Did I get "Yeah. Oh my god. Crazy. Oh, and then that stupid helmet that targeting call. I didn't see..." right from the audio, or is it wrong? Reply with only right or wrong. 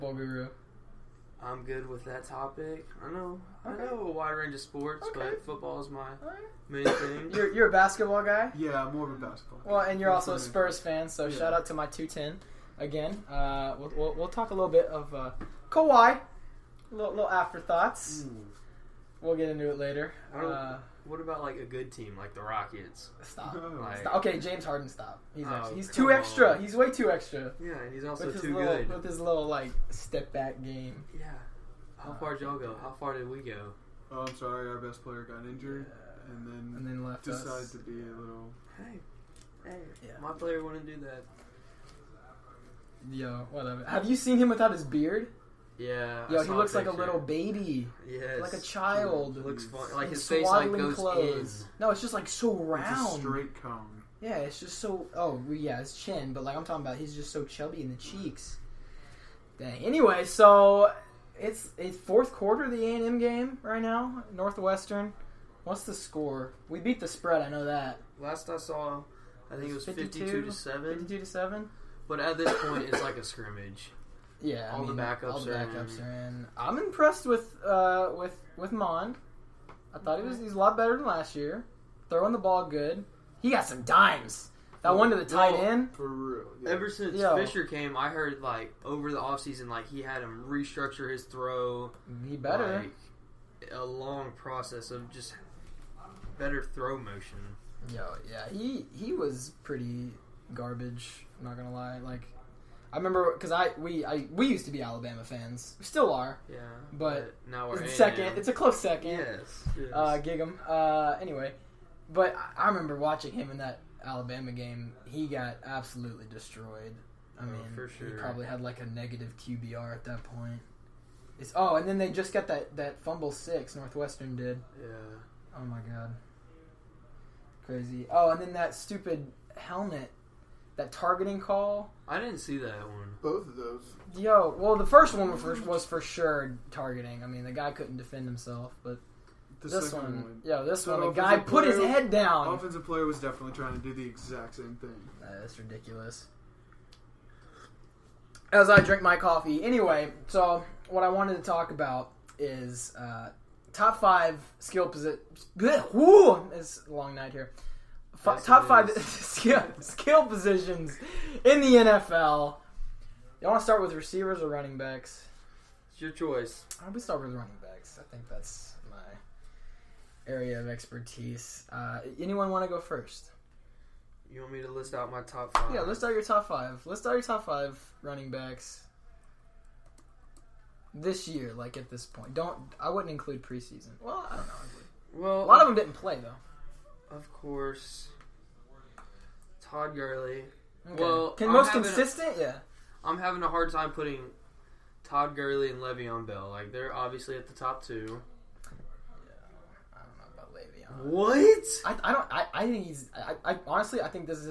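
right.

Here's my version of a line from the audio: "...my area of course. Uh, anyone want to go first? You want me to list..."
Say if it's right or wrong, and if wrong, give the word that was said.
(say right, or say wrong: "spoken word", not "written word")
wrong: "expertise", not "course".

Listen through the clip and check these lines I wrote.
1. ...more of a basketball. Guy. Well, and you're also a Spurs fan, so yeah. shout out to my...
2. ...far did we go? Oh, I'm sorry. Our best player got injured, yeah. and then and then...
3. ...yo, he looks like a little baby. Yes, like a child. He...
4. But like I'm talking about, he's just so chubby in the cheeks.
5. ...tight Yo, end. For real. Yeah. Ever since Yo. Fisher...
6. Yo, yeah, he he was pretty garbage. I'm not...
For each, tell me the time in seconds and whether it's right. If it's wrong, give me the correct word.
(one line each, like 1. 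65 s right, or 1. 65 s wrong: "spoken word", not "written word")
1. 8 s right
2. 32 s right
3. 46 s right
4. 56 s right
5. 85 s right
6. 97 s right.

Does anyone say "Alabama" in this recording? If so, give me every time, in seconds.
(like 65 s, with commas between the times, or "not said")
104 s, 114 s.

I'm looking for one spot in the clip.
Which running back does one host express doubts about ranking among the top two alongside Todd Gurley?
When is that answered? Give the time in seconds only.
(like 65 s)
195 s.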